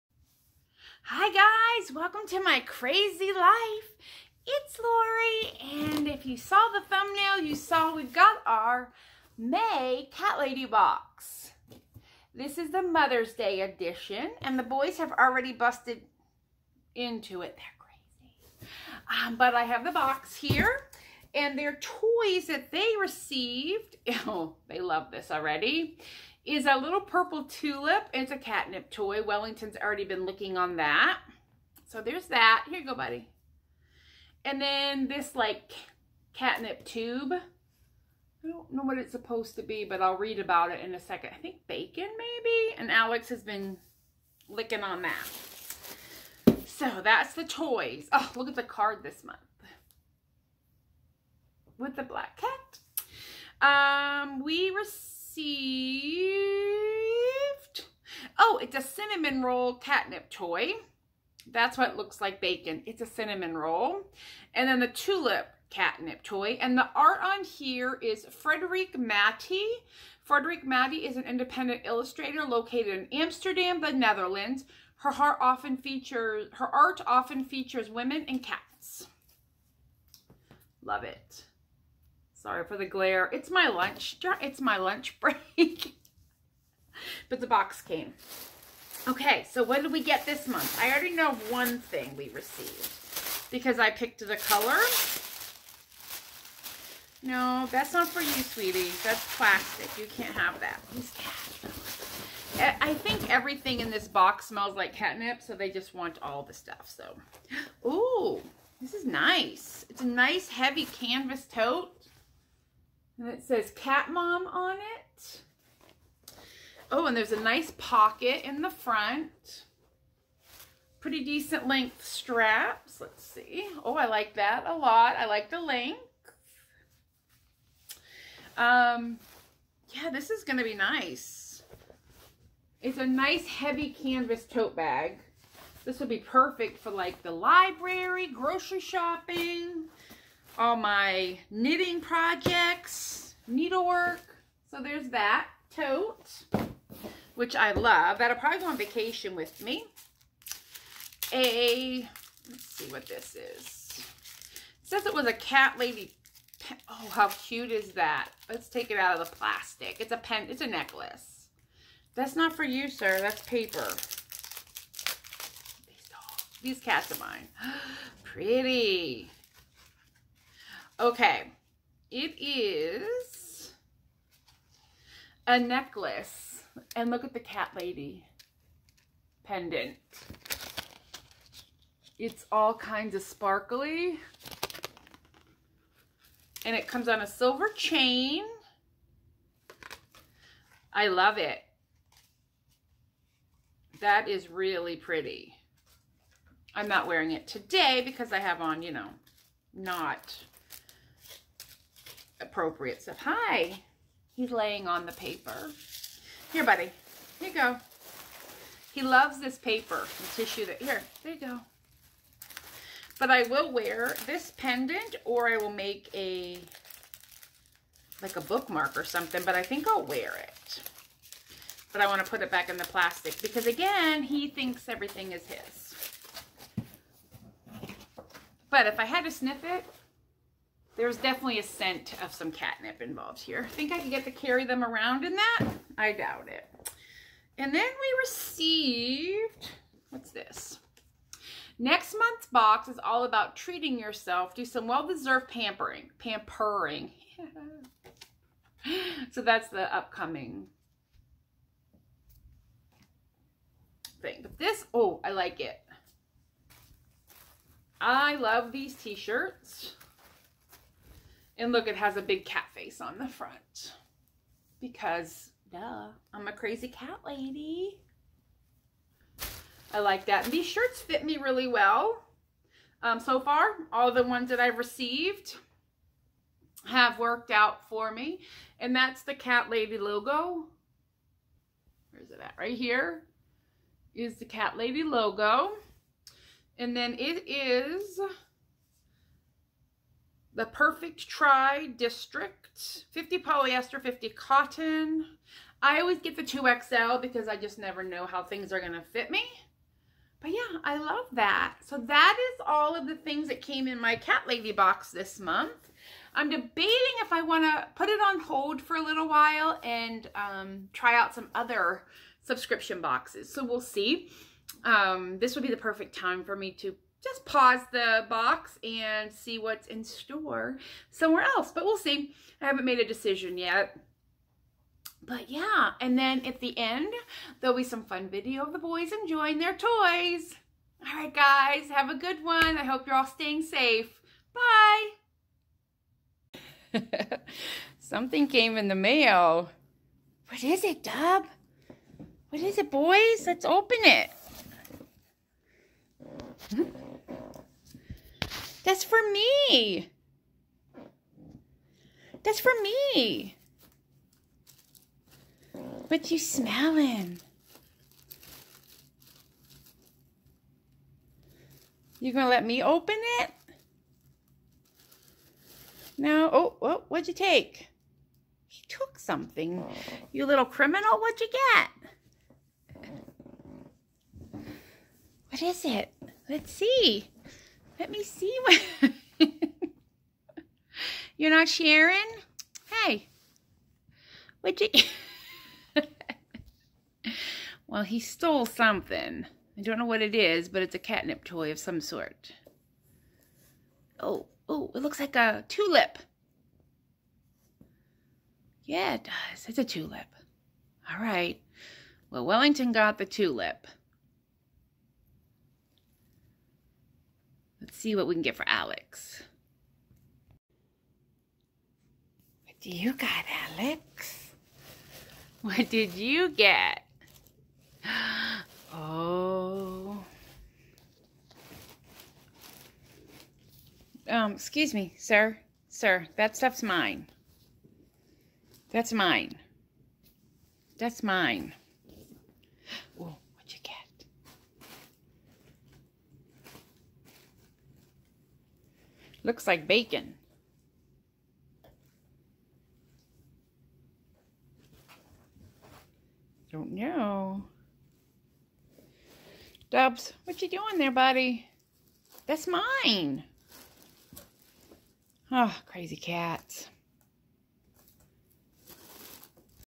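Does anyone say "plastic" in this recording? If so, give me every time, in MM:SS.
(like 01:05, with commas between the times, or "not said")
01:39, 02:39, 03:42.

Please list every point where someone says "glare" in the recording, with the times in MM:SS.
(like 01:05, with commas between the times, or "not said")
01:22.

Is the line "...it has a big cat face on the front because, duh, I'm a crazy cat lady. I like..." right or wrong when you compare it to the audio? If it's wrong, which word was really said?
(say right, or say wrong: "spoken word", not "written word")
right.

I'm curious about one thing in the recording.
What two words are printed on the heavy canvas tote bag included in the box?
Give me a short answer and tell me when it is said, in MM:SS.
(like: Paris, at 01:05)
Cat Mom, at 01:53.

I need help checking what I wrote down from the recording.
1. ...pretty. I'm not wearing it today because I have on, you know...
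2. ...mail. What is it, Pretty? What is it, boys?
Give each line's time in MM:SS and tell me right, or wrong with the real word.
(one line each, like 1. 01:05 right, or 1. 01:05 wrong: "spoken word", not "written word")
1. 03:14 right
2. 05:38 wrong: "Dub", not "Pretty".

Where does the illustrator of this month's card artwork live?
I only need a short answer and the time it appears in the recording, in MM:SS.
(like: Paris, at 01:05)
Amsterdam, at 01:13.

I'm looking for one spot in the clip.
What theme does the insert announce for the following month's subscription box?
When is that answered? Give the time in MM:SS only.
04:03.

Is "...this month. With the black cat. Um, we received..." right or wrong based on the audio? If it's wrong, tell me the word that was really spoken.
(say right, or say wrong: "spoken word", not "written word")
right.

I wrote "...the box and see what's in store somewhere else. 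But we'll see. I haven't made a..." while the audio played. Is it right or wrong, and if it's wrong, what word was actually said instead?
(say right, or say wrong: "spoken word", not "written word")
right.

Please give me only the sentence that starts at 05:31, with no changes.
All right, guys, have a good one.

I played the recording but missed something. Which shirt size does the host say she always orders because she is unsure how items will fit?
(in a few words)
2XL.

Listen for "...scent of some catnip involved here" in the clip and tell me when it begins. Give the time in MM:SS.
03:51.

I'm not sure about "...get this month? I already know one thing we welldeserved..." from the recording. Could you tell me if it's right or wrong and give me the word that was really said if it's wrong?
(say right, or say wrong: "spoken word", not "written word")
wrong: "received", not "welldeserved".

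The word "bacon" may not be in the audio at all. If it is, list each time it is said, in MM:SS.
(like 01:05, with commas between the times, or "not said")
00:41, 01:02, 07:19.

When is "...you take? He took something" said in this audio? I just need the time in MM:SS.
06:07.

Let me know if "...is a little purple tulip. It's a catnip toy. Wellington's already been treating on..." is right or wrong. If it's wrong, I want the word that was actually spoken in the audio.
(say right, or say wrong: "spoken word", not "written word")
wrong: "licking", not "treating".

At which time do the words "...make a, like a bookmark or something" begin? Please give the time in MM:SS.
03:35.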